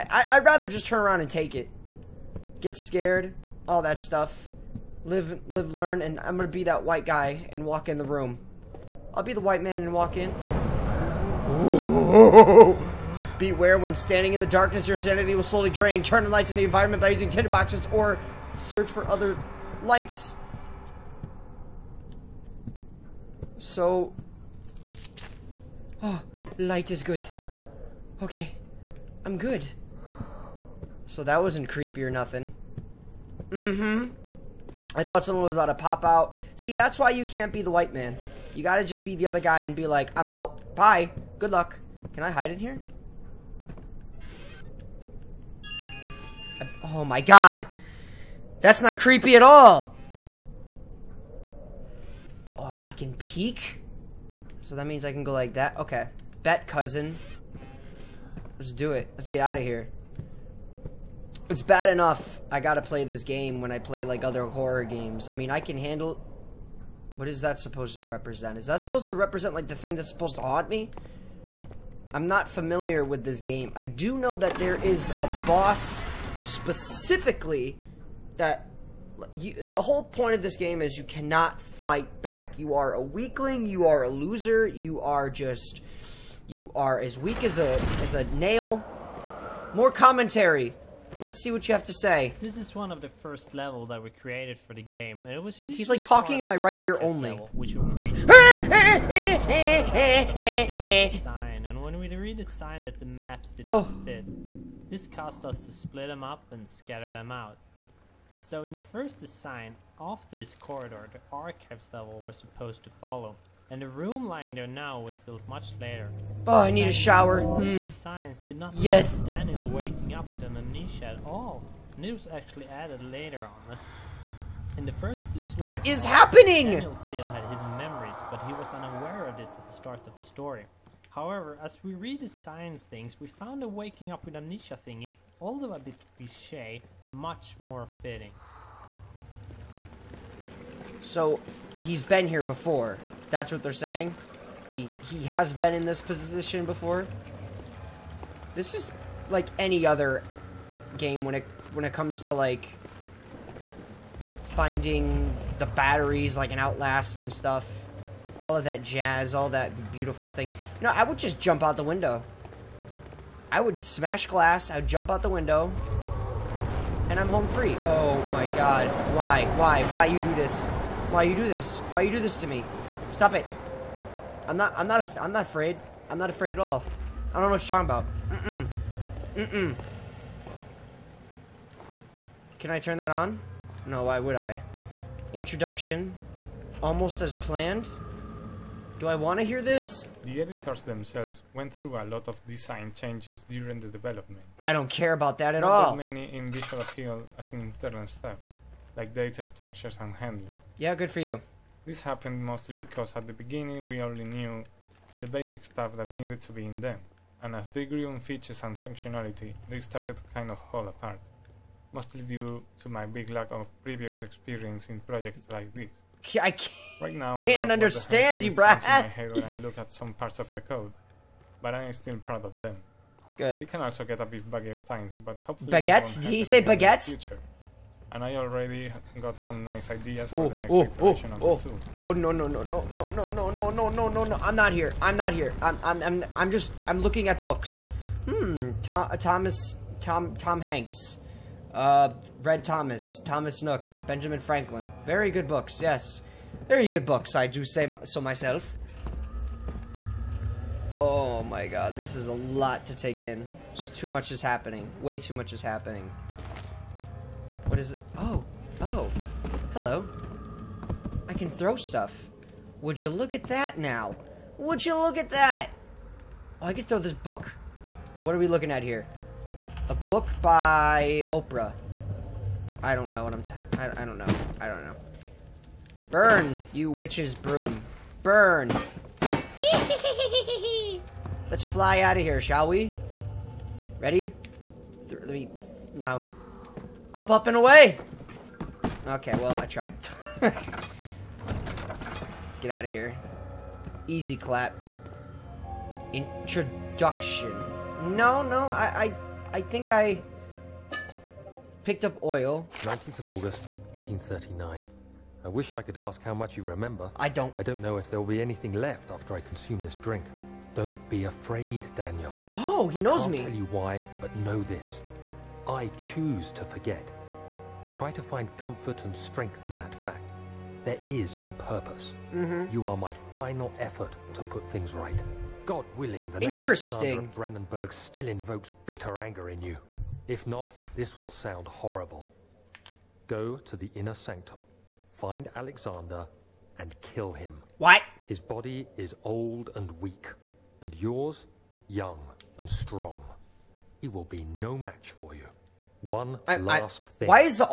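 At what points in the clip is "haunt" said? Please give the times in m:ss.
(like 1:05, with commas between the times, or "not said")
1:10.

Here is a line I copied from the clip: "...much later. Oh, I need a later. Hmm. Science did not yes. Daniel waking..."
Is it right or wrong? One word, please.
wrong.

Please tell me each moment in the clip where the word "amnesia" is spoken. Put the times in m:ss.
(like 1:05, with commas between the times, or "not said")
2:00, 2:14.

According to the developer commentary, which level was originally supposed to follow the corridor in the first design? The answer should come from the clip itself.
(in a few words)
archives level.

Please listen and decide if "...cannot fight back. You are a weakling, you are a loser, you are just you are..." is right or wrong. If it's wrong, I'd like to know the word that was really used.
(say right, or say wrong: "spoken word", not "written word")
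right.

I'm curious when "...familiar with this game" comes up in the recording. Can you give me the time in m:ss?
1:12.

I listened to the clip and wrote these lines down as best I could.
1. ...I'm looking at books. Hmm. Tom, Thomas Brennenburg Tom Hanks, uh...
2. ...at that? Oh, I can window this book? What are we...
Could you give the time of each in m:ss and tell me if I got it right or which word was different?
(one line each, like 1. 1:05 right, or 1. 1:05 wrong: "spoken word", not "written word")
1. 3:56 wrong: "Tom", not "Brennenburg"
2. 4:25 wrong: "throw", not "window".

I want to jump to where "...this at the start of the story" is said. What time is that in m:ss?
2:09.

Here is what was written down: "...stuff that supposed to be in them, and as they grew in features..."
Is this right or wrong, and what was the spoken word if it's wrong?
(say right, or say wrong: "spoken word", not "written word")
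wrong: "needed", not "supposed".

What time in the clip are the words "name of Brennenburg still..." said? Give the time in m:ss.
5:27.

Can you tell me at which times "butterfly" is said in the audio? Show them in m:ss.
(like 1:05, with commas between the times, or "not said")
not said.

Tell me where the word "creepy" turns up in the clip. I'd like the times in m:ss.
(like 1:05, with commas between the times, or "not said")
0:31, 0:48.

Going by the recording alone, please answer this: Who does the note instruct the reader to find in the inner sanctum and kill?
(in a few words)
Alexander.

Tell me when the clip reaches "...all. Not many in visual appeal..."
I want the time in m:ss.
3:15.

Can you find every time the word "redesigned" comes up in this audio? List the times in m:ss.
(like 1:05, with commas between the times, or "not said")
1:42, 2:11.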